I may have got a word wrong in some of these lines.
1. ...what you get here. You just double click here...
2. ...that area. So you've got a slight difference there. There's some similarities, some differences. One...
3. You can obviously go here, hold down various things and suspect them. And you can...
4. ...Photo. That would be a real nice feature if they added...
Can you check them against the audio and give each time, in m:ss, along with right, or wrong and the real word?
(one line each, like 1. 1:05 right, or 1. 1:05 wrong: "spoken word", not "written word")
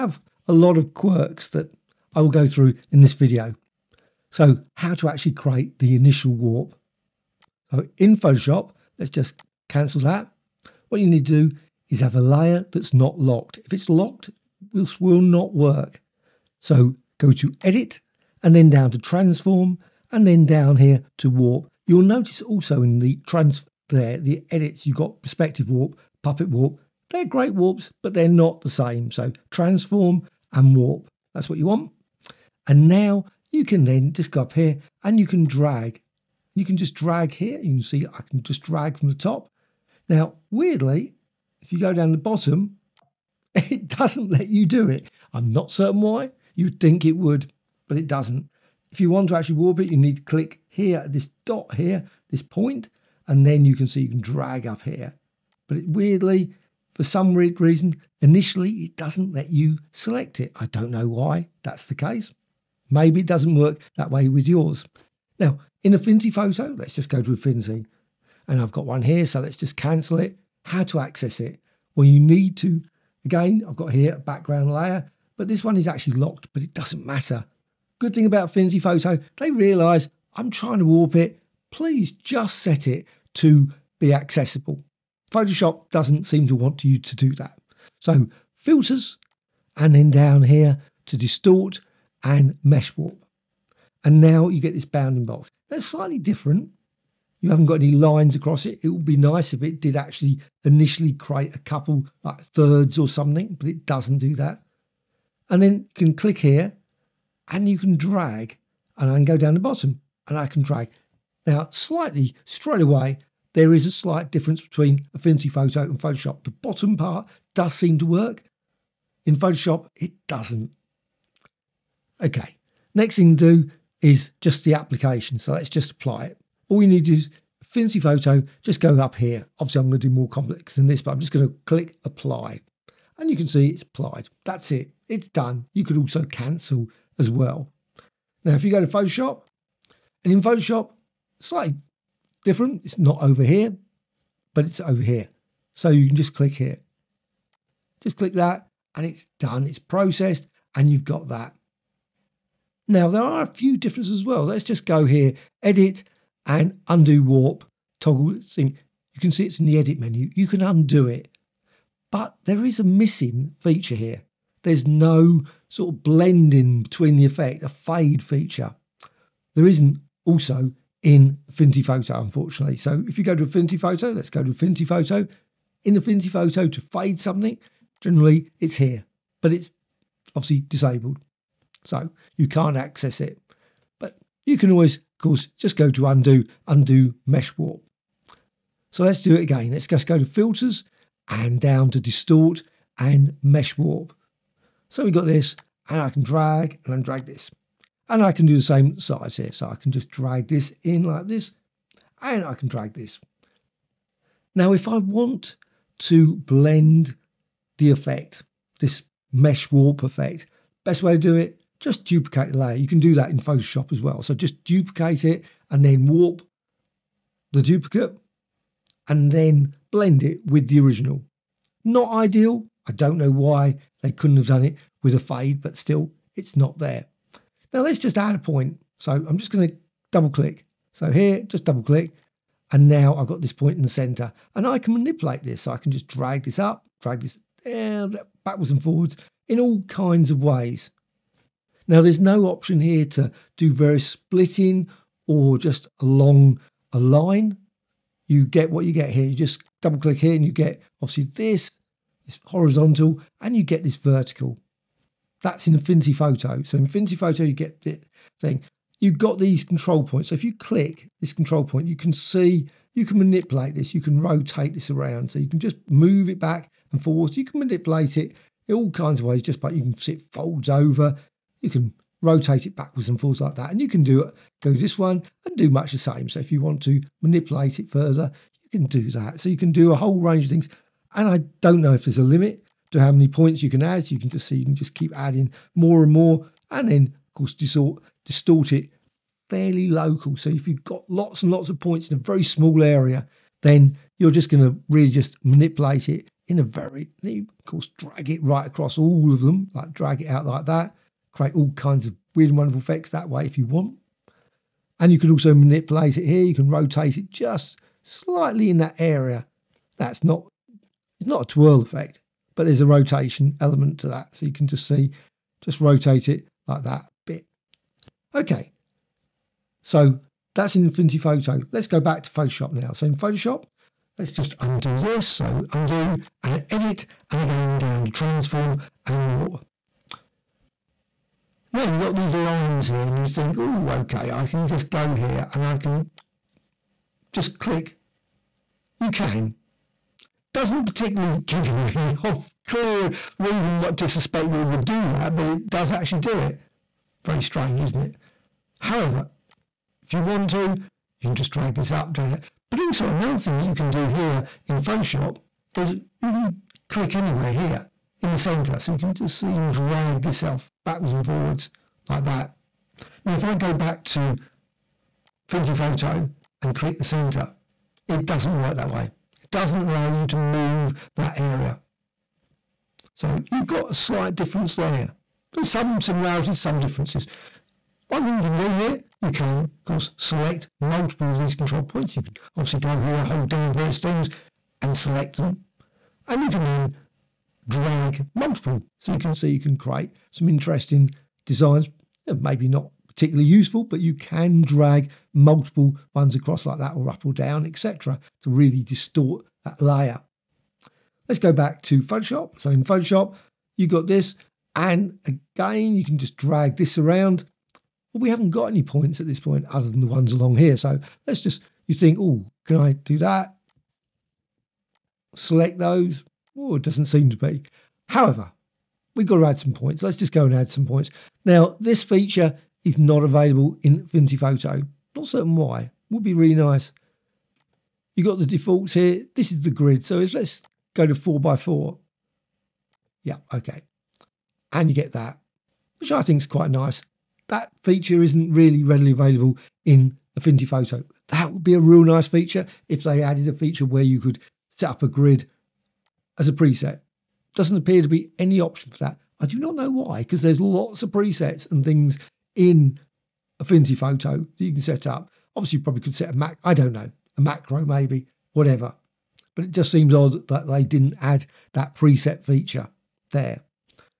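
1. 4:08 right
2. 6:11 right
3. 6:22 wrong: "select", not "suspect"
4. 7:20 right.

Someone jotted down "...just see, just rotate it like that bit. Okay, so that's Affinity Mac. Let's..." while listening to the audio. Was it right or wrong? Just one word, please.
wrong.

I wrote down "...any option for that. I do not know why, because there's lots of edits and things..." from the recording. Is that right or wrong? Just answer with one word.
wrong.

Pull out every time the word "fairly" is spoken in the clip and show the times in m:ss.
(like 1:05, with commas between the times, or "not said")
4:49.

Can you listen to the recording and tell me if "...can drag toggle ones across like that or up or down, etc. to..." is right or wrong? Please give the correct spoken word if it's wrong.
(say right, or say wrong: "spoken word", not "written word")
wrong: "multiple", not "toggle".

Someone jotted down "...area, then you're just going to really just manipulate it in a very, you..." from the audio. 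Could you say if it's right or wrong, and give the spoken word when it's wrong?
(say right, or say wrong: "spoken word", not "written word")
right.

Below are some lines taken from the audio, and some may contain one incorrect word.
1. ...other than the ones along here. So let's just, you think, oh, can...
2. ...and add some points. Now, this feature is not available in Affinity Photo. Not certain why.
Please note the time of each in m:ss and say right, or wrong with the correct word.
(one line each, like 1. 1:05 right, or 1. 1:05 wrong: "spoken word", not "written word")
1. 6:49 right
2. 7:00 right.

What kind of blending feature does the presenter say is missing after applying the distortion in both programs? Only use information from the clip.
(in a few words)
A fade feature.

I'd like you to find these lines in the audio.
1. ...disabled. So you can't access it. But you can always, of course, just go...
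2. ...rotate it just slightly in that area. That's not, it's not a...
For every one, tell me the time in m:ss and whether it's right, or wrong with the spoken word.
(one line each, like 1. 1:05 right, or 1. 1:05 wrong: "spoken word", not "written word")
1. 3:00 right
2. 5:06 right.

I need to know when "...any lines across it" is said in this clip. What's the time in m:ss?
1:37.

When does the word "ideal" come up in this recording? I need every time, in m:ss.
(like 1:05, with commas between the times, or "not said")
3:42.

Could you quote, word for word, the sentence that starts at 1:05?
Now, in Affinity Photo, let's just go to Affinity.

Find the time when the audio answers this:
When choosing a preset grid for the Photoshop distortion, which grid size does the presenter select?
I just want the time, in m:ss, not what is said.
7:11.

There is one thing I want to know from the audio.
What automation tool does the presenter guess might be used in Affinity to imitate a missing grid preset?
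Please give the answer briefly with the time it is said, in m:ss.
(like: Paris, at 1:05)
A macro, at 7:37.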